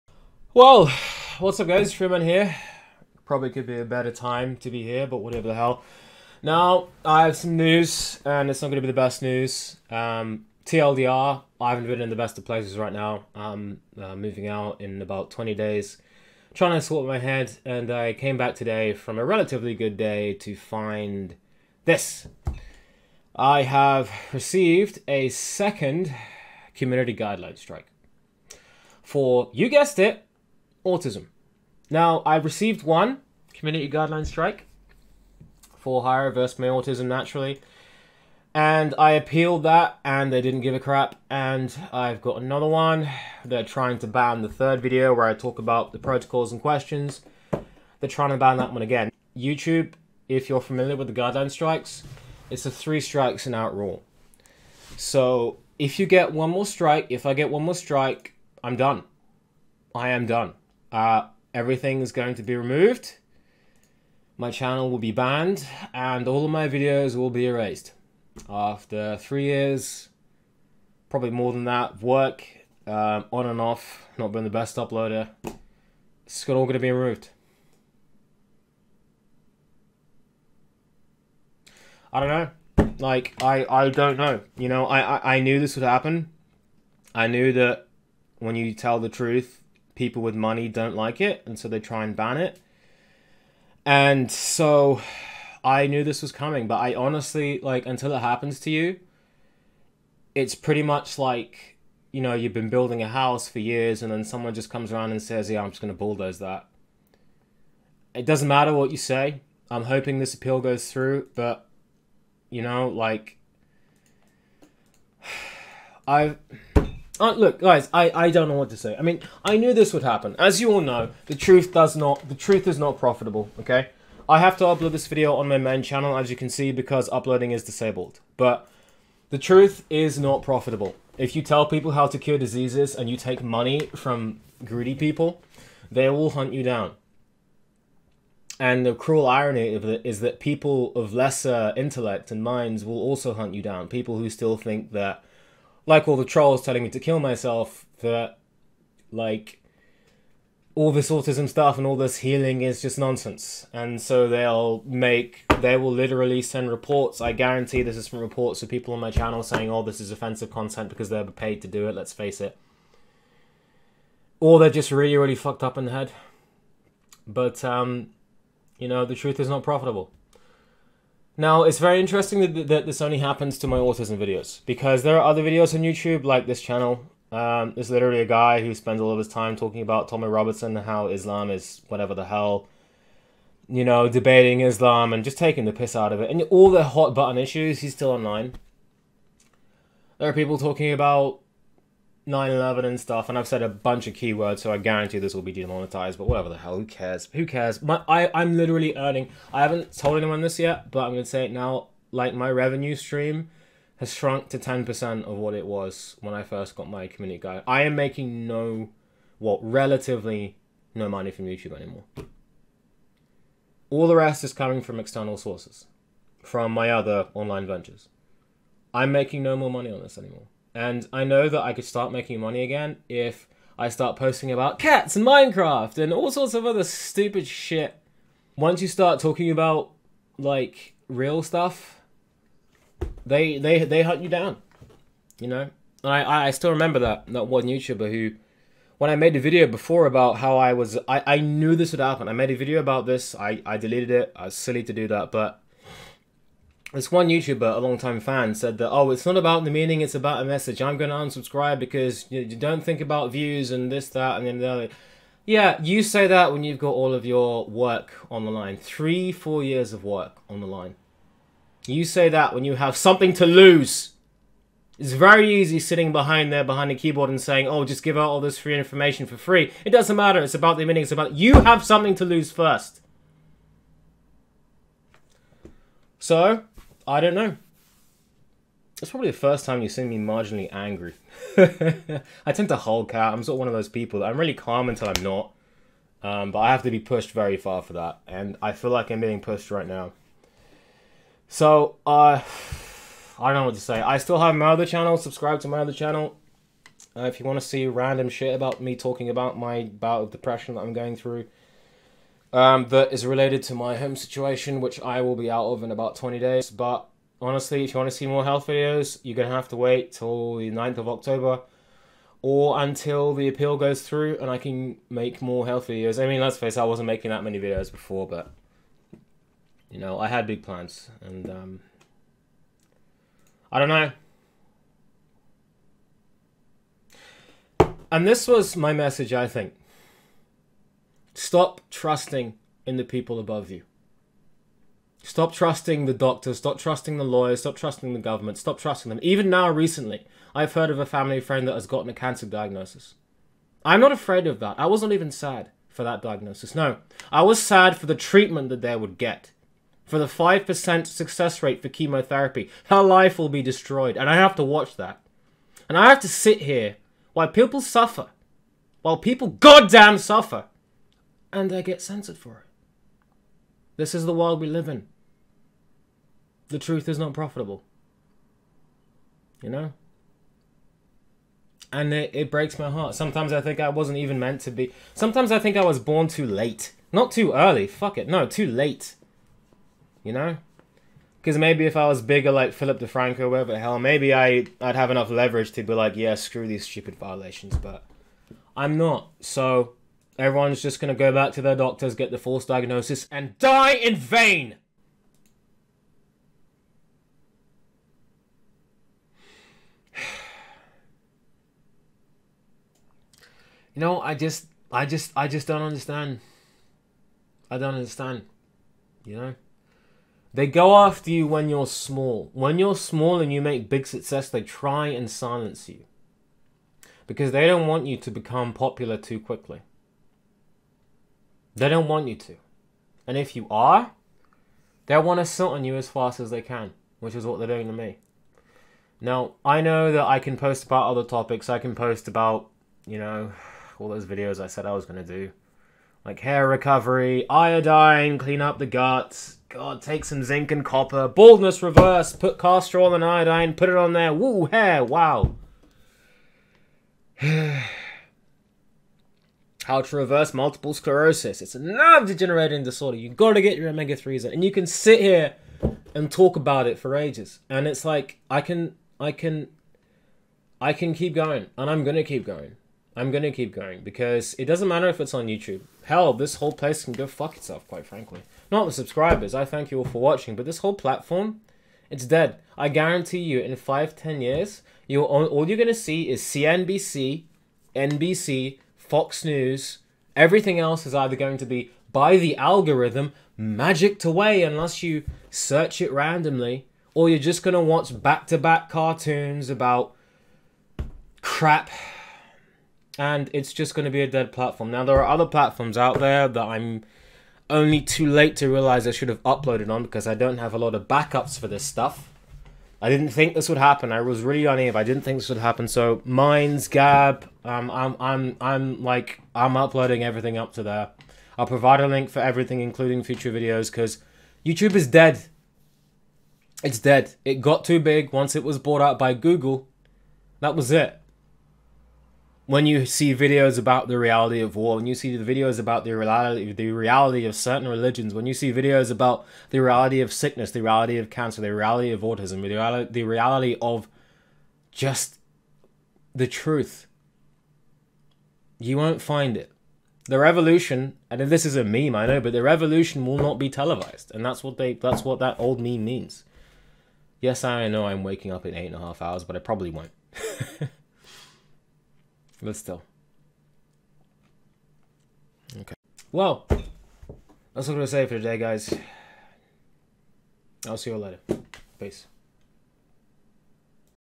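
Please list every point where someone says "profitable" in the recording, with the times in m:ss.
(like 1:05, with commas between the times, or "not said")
2:02, 2:10, 2:49, 6:07.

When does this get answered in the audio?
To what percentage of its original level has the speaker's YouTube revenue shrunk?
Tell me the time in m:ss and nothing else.
3:24.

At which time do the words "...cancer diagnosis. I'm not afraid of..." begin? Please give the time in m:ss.
5:42.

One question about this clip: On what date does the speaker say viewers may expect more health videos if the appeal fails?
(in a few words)
9th of October.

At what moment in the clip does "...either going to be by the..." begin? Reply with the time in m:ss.
8:01.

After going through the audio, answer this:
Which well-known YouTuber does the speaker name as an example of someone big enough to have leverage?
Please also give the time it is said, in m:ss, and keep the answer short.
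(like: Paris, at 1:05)
Philip DeFranco, at 6:22.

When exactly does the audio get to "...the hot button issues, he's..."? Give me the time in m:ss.
3:06.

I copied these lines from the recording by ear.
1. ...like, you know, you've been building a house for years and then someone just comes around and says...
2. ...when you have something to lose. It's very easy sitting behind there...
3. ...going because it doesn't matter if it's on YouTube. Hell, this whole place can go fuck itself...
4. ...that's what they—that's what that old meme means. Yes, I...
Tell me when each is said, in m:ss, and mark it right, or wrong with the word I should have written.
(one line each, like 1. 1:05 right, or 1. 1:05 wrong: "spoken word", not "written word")
1. 1:41 right
2. 4:22 right
3. 7:43 right
4. 9:04 right.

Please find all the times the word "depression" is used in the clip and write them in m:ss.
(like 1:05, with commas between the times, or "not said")
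5:00.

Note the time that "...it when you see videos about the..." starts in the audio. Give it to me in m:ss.
8:40.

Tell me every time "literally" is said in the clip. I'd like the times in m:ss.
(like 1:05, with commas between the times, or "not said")
2:35, 2:57, 3:18.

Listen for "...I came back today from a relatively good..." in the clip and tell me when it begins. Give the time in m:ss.
0:17.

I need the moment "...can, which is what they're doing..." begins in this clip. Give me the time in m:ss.
7:06.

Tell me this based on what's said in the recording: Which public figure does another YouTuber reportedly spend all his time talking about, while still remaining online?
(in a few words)
Tommy Robertson.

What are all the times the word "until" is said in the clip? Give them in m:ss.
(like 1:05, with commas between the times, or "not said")
1:37, 4:44, 5:12.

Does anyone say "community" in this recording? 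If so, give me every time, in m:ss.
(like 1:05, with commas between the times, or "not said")
0:26, 0:33, 3:27.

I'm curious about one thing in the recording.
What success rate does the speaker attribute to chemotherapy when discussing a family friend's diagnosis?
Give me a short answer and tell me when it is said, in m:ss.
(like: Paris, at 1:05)
5%, at 5:50.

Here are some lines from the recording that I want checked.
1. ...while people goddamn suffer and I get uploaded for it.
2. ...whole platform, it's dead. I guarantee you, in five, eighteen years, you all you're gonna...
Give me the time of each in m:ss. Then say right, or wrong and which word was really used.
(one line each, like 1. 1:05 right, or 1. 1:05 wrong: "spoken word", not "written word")
1. 5:59 wrong: "censored", not "uploaded"
2. 7:50 wrong: "ten", not "eighteen".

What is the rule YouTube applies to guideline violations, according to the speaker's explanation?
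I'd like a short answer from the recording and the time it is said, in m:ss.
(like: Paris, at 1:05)
three strikes and out, at 0:52.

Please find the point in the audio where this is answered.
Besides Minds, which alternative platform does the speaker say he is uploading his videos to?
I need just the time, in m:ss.
8:26.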